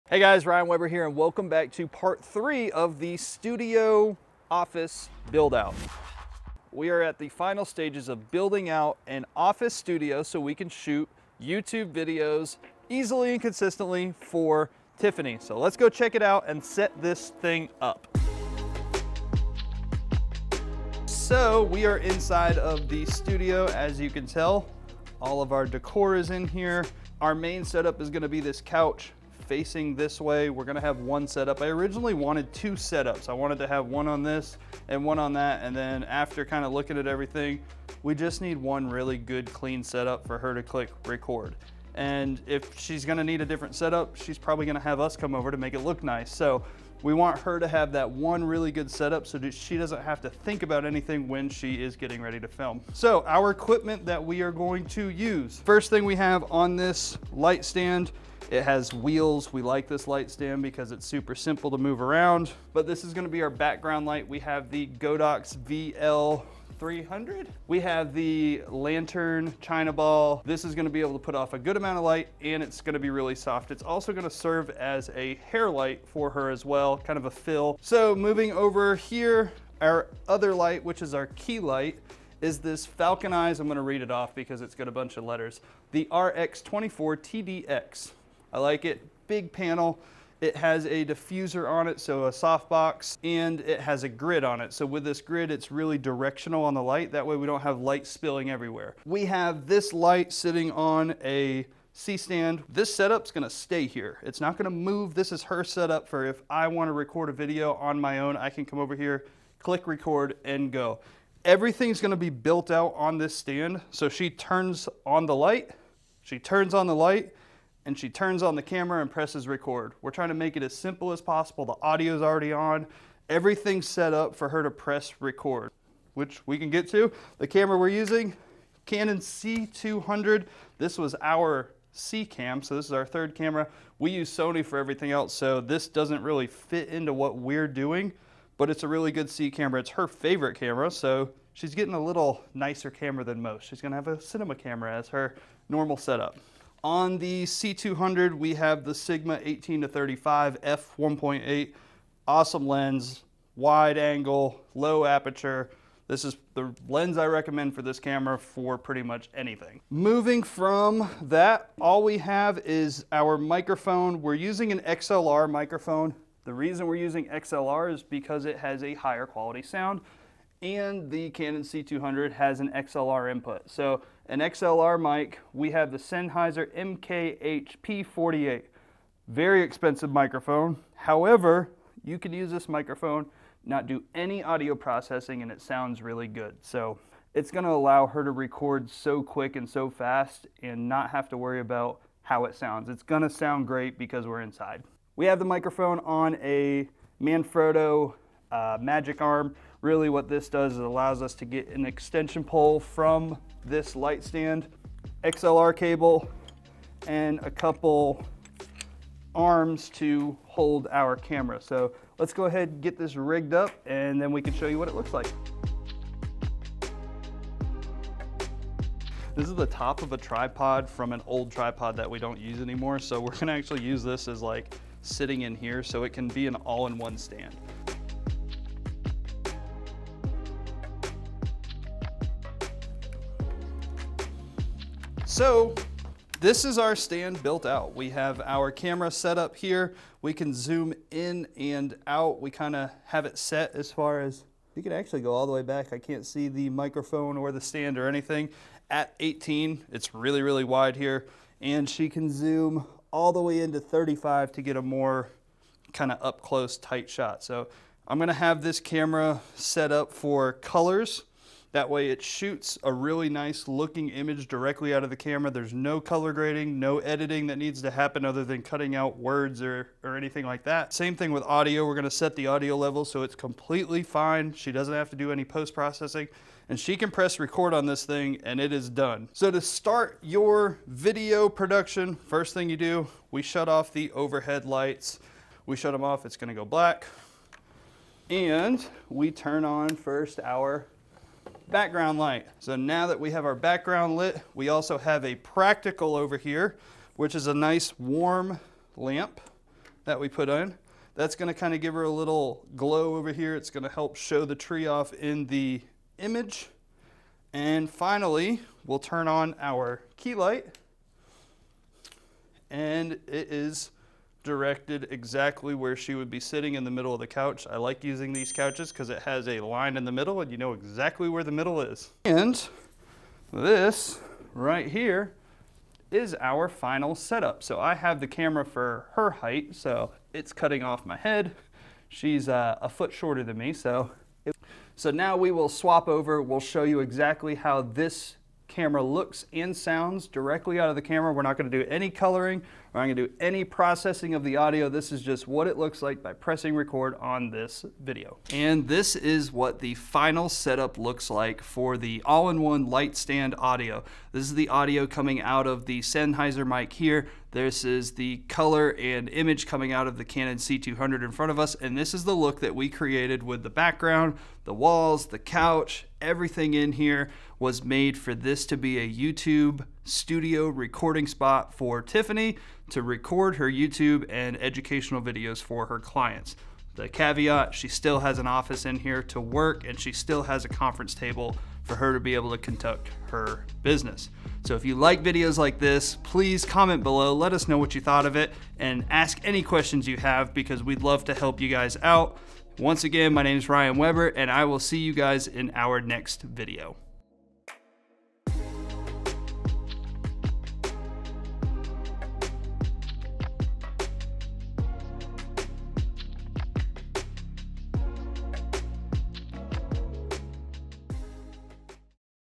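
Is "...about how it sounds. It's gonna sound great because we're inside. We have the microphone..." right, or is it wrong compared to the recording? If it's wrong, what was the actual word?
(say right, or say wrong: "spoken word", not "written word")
right.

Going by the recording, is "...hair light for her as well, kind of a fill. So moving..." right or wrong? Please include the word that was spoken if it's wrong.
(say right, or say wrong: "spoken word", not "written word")
right.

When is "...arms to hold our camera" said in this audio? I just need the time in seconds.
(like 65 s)
209 s.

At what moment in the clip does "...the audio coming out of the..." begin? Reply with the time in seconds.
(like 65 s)
354 s.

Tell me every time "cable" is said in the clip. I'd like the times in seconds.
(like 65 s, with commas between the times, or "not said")
205 s.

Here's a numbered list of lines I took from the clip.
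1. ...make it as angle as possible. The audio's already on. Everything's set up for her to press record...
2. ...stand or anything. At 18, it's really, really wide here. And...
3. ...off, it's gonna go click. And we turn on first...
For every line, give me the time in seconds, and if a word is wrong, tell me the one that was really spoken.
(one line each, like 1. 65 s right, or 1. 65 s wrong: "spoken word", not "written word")
1. 120 s wrong: "simple", not "angle"
2. 247 s right
3. 286 s wrong: "black", not "click".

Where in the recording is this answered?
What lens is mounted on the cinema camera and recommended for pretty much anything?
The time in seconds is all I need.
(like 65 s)
148 s.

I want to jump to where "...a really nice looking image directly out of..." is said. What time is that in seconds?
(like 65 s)
262 s.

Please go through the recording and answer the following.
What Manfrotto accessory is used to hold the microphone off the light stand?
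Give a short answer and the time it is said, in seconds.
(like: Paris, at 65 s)
Magic Arm, at 198 s.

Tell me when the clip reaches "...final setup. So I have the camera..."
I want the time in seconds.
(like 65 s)
326 s.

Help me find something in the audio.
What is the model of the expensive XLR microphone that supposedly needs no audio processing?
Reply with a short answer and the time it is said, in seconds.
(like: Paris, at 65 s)
Sennheiser MKH-P48, at 175 s.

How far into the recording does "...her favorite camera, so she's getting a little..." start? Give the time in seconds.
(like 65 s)
139 s.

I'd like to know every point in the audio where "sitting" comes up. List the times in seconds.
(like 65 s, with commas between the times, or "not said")
100 s, 225 s, 316 s.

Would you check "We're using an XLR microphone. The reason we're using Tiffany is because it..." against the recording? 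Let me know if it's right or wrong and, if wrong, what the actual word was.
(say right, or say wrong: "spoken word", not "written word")
wrong: "XLR", not "Tiffany".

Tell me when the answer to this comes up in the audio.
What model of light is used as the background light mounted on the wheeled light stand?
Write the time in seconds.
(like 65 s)
64 s.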